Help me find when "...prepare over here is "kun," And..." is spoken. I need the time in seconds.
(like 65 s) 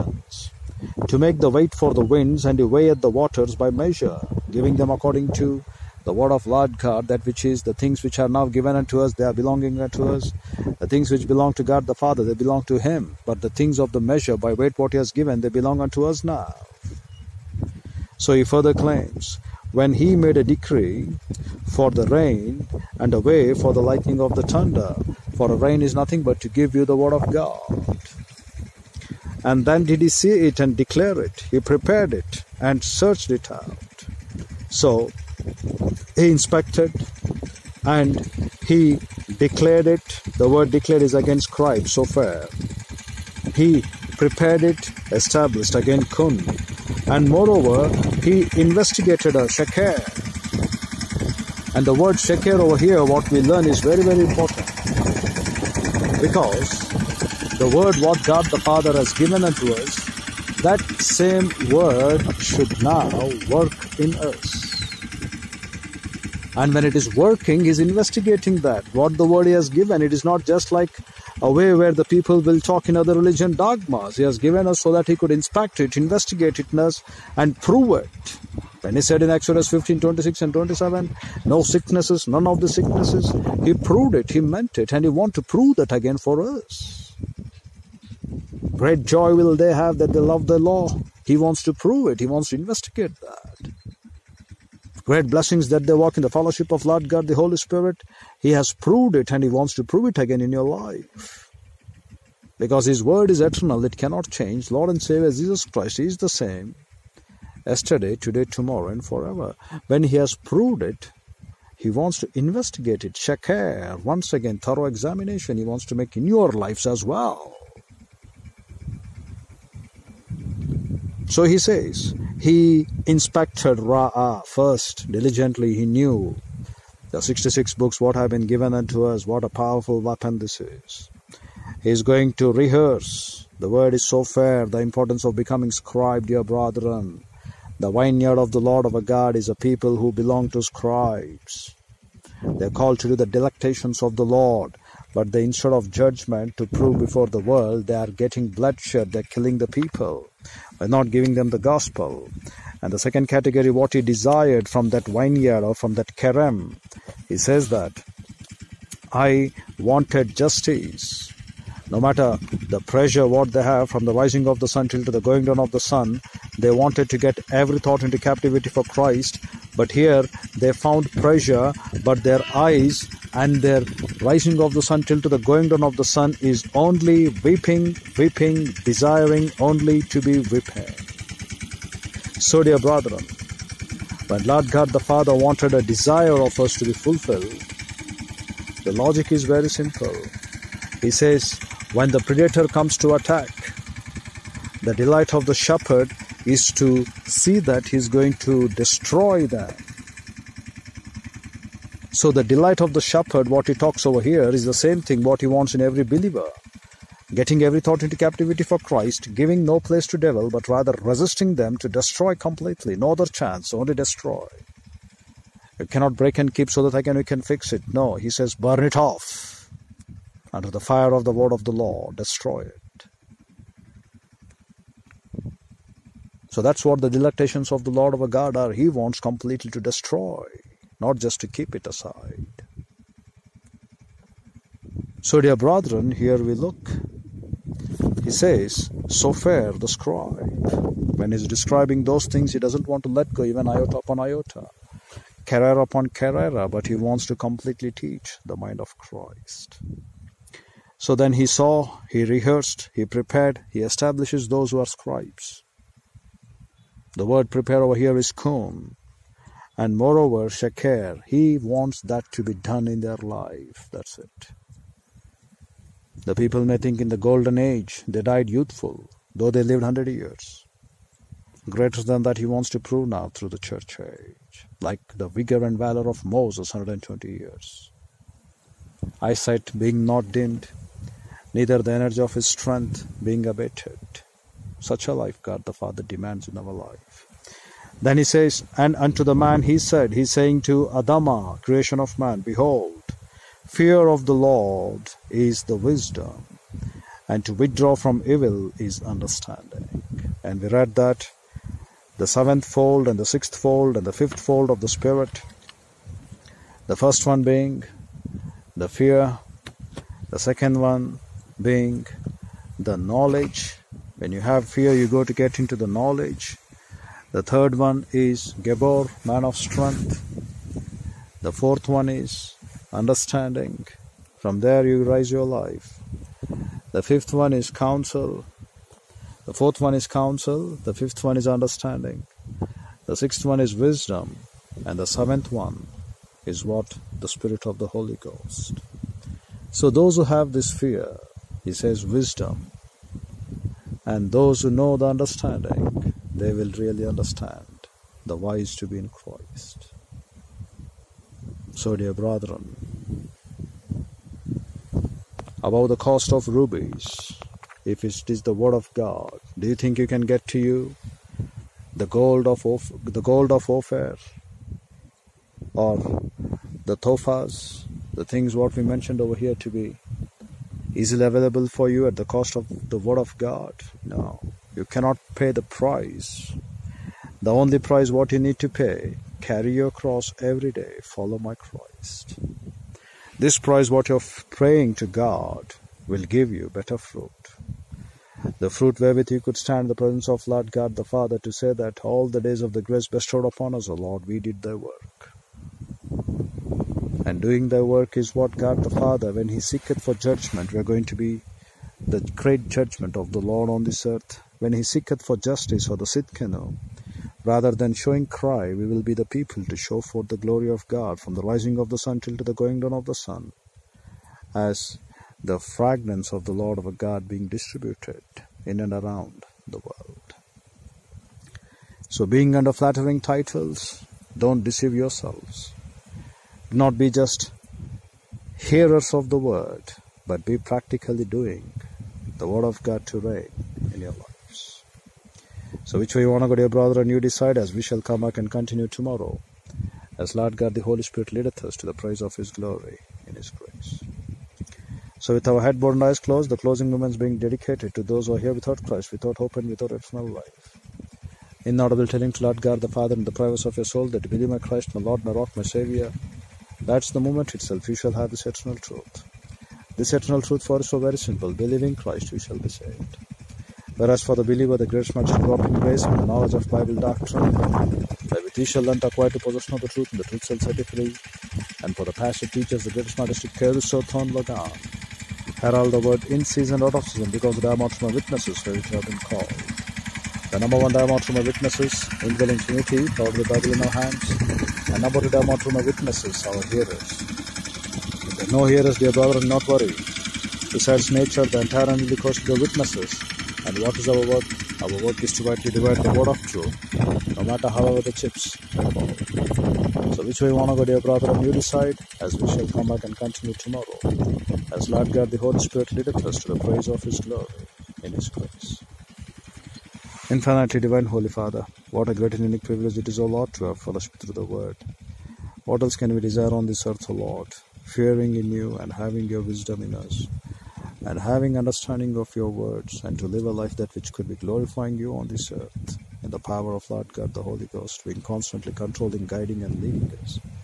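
257 s.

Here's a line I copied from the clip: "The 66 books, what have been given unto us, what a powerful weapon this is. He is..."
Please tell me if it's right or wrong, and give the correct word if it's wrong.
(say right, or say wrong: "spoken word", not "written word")
right.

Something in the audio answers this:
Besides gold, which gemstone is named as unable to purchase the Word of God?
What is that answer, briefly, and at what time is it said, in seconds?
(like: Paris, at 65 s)
topaz, at 366 s.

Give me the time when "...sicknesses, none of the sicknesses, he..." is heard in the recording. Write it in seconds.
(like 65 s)
81 s.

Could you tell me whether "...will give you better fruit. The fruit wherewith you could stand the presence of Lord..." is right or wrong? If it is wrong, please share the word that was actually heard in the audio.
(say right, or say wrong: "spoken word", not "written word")
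right.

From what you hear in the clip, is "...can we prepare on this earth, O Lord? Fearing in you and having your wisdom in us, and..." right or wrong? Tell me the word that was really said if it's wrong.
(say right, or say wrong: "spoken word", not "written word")
wrong: "desire", not "prepare".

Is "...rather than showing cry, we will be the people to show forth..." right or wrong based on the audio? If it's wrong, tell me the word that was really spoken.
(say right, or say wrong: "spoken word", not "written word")
right.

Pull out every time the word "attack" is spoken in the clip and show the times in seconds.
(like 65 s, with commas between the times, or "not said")
193 s.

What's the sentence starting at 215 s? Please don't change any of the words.
You cannot break and keep so that I can, you can fix it.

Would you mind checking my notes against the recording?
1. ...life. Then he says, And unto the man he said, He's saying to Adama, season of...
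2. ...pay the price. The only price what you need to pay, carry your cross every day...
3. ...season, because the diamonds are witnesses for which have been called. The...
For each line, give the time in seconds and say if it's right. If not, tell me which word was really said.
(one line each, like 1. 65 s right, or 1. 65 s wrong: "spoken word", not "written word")
1. 286 s wrong: "creation", not "season"
2. 375 s right
3. 477 s right.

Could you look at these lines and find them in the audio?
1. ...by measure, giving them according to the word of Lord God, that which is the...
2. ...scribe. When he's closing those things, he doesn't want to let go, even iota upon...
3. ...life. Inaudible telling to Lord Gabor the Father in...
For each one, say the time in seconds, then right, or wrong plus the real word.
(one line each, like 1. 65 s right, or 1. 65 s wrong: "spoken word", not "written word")
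1. 3 s right
2. 239 s wrong: "describing", not "closing"
3. 450 s wrong: "God", not "Gabor".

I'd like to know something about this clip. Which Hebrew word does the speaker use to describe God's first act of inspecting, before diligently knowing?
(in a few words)
Ra'a.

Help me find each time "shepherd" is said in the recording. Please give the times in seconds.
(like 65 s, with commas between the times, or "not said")
195 s, 203 s.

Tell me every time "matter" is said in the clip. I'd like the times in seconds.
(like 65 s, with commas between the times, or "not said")
161 s, 497 s.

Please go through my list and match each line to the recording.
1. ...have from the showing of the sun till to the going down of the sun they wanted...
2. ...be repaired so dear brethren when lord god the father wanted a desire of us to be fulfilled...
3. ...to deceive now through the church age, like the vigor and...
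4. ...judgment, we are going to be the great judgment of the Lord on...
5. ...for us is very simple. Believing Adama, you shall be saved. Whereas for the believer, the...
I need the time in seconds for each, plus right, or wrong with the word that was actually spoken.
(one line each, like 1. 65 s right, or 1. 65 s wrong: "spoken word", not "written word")
1. 163 s wrong: "rising", not "showing"
2. 180 s right
3. 272 s wrong: "prove", not "deceive"
4. 400 s right
5. 460 s wrong: "Christ", not "Adama".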